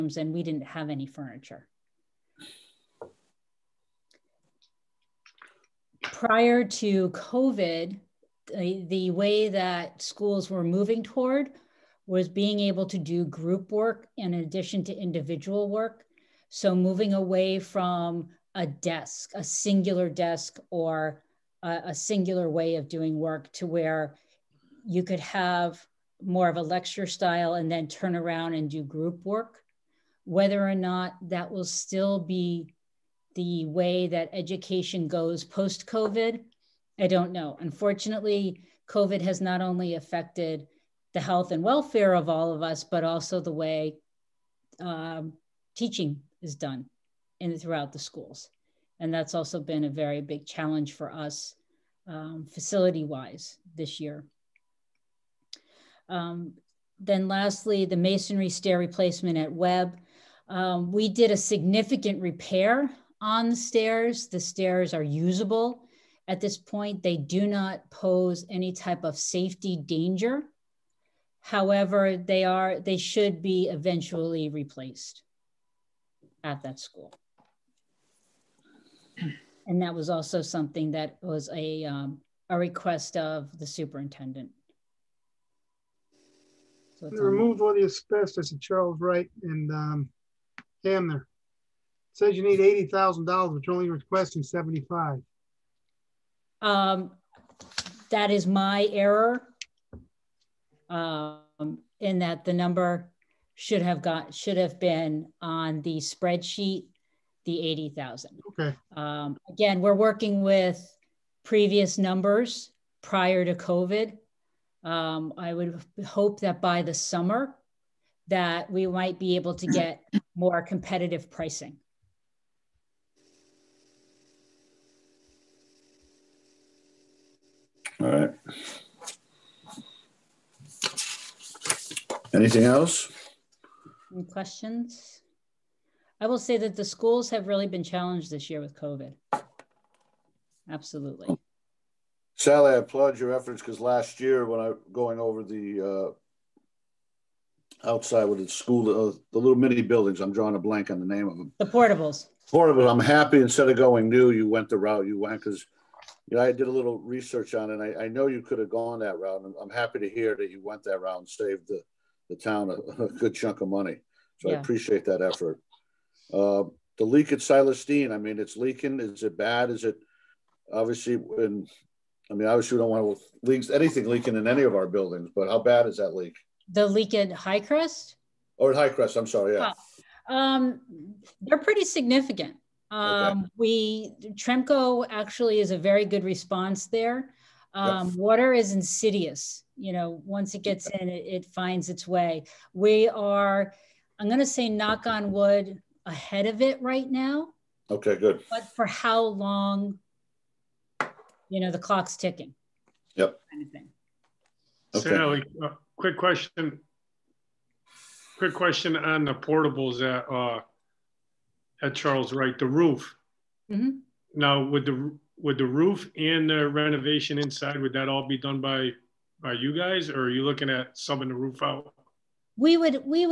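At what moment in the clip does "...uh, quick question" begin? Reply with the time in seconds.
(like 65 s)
205 s.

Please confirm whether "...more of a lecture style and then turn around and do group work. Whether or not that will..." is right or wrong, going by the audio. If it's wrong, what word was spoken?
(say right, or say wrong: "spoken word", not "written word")
right.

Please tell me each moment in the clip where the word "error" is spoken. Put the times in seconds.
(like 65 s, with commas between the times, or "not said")
98 s.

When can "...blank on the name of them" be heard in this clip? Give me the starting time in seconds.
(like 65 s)
150 s.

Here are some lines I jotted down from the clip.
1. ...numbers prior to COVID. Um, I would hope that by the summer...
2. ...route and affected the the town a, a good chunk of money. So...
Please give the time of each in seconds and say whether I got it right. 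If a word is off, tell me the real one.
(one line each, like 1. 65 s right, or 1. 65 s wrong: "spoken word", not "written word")
1. 111 s right
2. 161 s wrong: "saved", not "affected".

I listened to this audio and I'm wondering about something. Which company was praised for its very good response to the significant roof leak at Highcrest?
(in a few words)
Tremco.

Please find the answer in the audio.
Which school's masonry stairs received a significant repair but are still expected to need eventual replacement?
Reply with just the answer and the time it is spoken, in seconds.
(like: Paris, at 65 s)
Webb, at 59 s.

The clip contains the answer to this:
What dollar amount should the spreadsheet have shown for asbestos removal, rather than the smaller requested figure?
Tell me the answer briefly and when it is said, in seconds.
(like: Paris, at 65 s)
$80,000, at 92 s.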